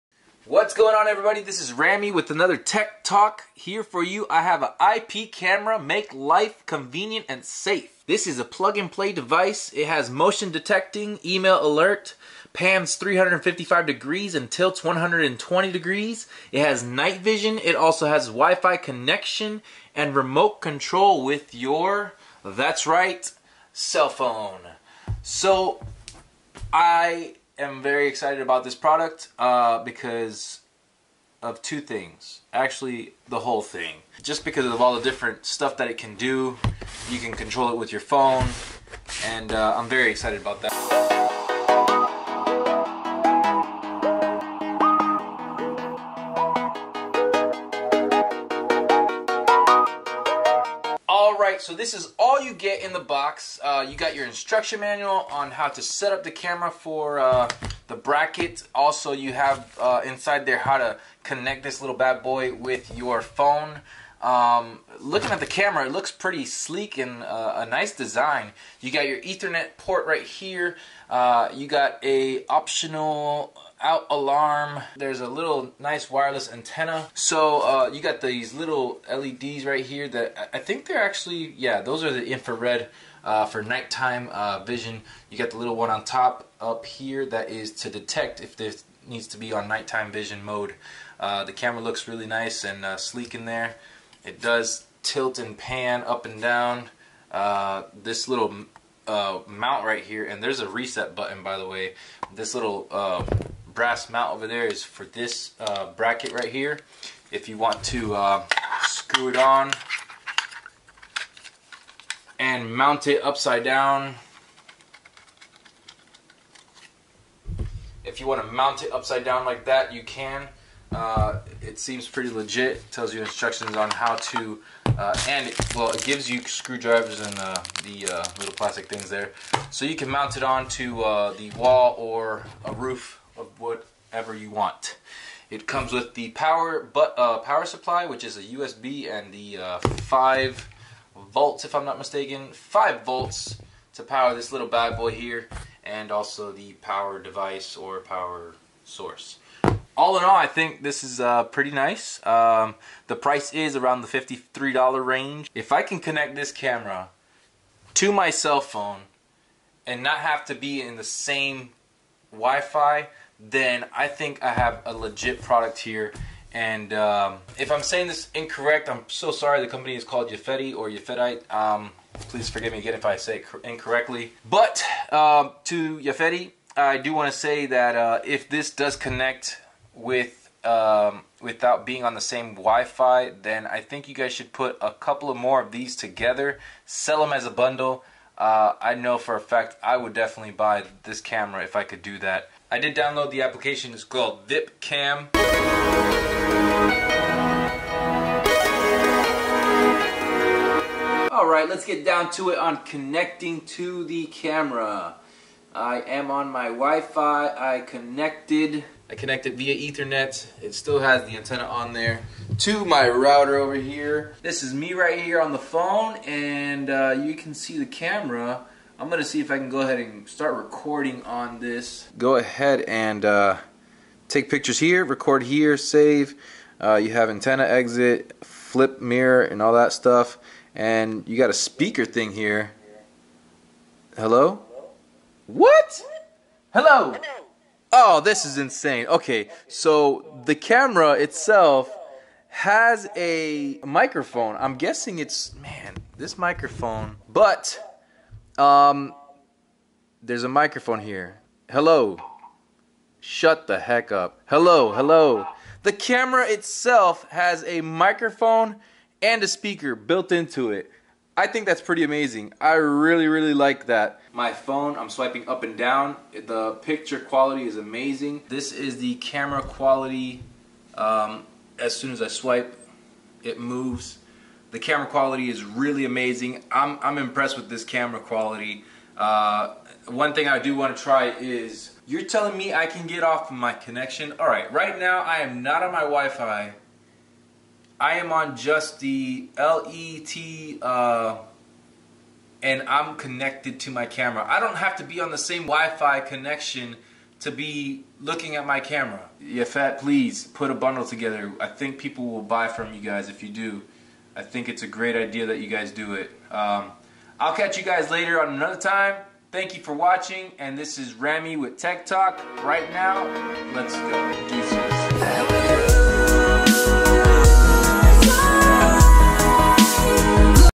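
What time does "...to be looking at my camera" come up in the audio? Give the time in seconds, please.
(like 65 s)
297 s.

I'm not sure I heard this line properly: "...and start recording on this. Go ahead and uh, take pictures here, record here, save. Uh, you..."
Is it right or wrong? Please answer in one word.
right.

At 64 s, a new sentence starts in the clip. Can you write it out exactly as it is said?
Um, looking at the camera, it looks pretty sleek and uh, a nice design.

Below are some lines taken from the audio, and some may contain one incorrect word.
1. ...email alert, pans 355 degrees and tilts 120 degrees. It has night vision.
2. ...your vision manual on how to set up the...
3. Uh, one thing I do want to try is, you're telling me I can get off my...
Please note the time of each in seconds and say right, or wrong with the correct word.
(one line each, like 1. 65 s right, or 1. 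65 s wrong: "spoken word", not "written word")
1. 11 s right
2. 54 s wrong: "instruction", not "vision"
3. 279 s right.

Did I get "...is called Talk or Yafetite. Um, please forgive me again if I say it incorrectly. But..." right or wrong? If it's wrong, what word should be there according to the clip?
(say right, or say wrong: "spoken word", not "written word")
wrong: "Yafeti", not "Talk".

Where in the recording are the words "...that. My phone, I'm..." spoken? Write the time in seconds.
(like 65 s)
263 s.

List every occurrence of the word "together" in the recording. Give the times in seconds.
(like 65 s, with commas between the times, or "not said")
185 s, 301 s.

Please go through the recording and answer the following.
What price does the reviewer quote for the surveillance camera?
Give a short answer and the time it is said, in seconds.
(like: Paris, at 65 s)
$53, at 154 s.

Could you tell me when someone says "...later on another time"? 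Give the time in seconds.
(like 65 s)
308 s.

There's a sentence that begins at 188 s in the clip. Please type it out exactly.
Uh, I know for a fact I would definitely buy this camera if I could do that.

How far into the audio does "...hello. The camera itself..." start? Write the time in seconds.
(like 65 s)
254 s.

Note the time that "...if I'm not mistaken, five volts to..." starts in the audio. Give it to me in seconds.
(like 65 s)
141 s.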